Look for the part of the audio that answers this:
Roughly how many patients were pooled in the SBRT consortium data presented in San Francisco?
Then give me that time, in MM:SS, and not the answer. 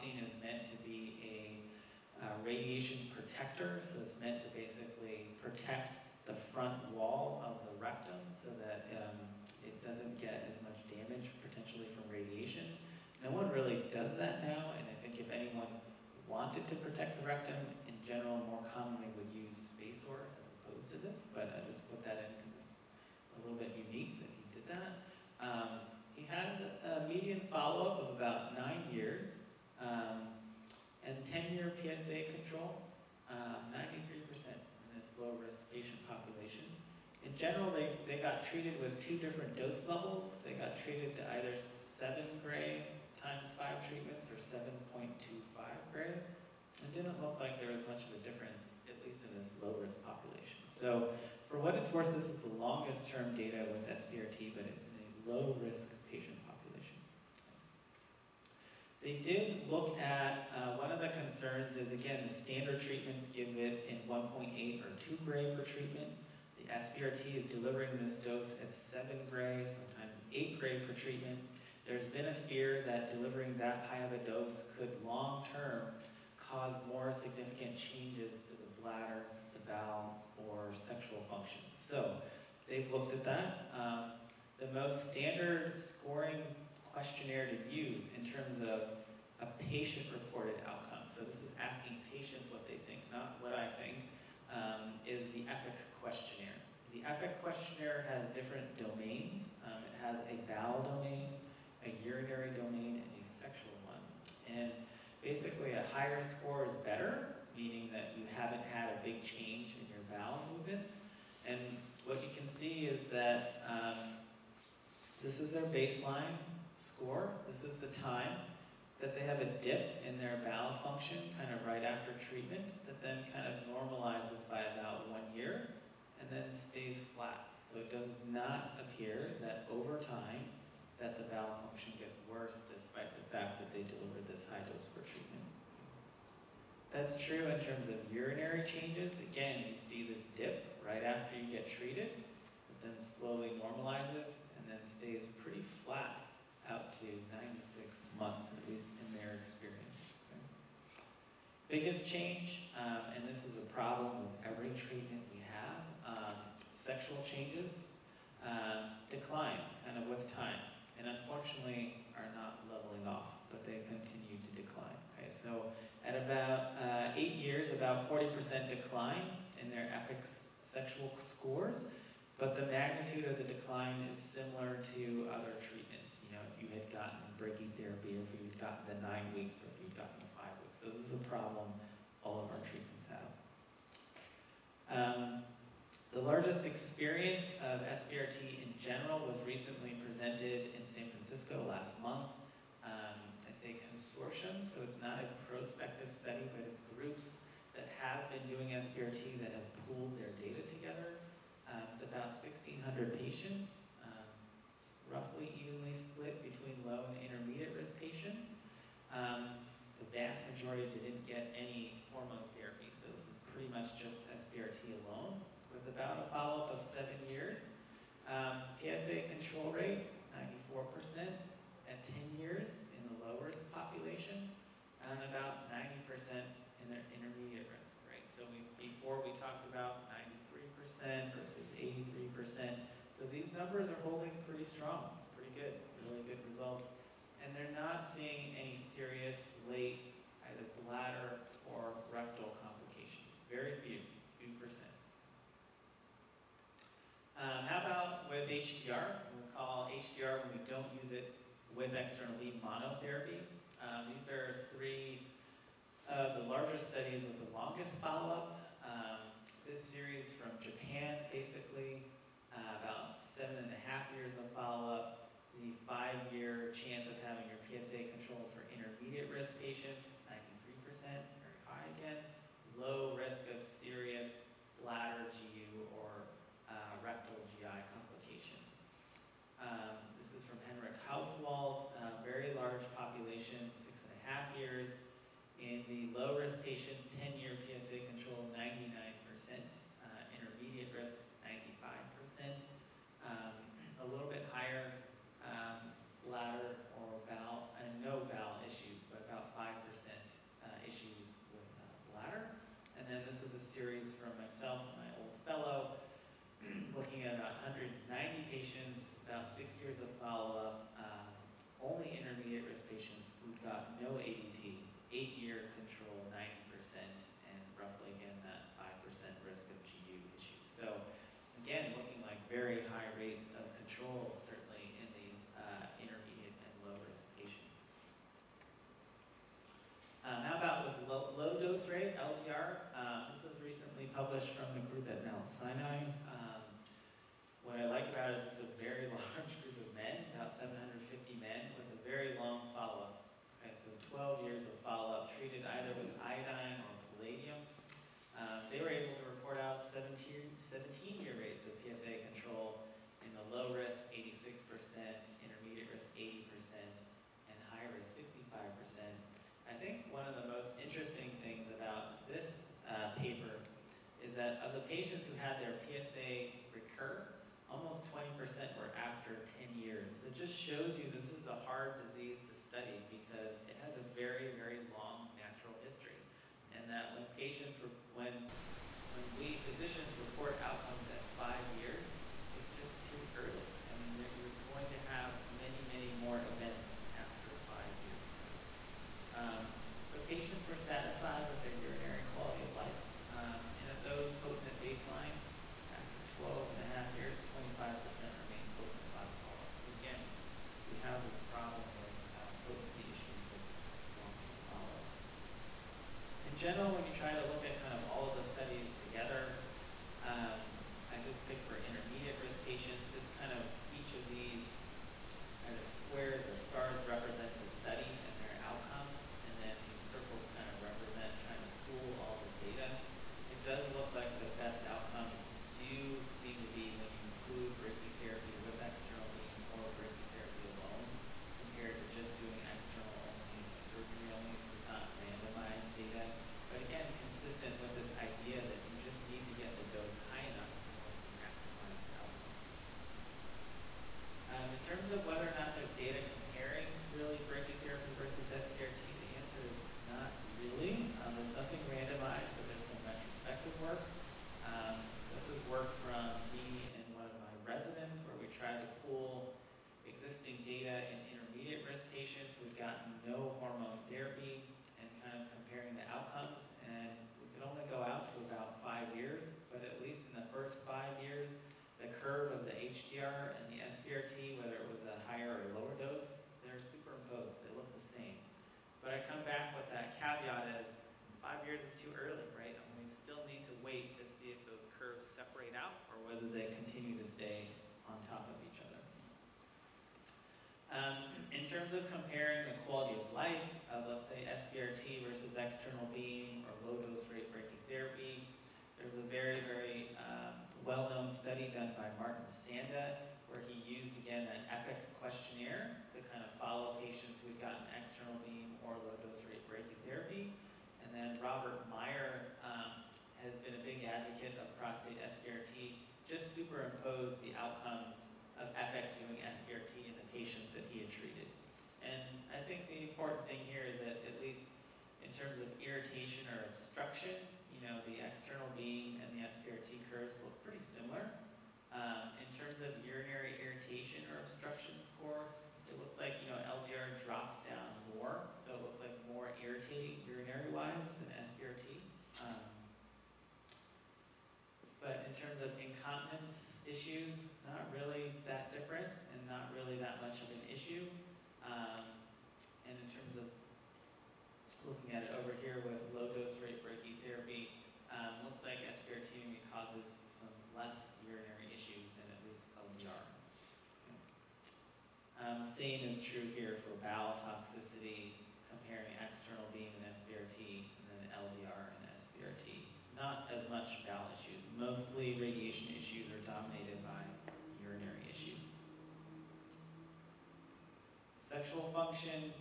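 03:22.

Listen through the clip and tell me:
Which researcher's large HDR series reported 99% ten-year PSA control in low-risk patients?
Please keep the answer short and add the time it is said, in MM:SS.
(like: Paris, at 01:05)
Henrik Hauswald, at 04:40.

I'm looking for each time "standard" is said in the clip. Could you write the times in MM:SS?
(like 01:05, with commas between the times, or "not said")
01:02, 01:25.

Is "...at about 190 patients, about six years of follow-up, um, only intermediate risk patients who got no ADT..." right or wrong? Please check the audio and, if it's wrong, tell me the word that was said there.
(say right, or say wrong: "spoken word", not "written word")
right.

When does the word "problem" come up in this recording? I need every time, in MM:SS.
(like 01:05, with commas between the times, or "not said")
02:33, 03:01, 06:41.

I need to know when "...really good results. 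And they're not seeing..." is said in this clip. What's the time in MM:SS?
03:56.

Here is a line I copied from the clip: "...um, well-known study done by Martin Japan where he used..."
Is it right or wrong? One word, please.
wrong.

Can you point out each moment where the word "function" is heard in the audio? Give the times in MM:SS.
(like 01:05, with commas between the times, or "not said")
01:21, 02:00, 02:11, 09:41.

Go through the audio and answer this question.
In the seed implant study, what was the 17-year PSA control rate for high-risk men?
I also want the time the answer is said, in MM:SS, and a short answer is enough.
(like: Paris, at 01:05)
65%, at 05:58.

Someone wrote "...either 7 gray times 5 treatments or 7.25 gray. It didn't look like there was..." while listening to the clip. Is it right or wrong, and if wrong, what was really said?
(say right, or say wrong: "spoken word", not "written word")
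right.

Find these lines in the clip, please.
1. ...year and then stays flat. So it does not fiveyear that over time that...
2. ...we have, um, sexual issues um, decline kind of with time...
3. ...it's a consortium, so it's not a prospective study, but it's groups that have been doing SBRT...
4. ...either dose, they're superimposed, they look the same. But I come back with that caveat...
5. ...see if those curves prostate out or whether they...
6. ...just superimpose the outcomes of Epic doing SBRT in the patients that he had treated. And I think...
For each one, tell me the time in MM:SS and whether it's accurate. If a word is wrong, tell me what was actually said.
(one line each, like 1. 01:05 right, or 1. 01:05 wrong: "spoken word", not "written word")
1. 02:05 wrong: "appear", not "fiveyear"
2. 02:35 wrong: "changes", not "issues"
3. 03:13 right
4. 07:55 wrong: "lower", not "either"
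5. 08:04 wrong: "separate", not "prostate"
6. 08:36 right.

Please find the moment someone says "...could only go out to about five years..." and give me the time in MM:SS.
07:47.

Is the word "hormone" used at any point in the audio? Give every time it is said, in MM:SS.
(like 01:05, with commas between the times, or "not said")
03:32, 07:43.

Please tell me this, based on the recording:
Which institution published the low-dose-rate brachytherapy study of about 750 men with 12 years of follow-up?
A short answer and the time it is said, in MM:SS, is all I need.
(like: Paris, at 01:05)
Mount Sinai, at 05:35.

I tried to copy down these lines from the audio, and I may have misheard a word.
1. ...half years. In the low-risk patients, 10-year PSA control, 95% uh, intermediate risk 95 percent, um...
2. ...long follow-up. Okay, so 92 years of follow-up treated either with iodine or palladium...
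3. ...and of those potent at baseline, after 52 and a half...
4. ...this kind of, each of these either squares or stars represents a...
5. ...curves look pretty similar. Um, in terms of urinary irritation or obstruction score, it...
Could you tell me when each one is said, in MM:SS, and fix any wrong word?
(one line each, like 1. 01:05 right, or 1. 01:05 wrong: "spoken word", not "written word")
1. 04:44 wrong: "99", not "95"
2. 05:42 wrong: "12", not "92"
3. 06:33 wrong: "12", not "52"
4. 06:53 right
5. 08:50 right.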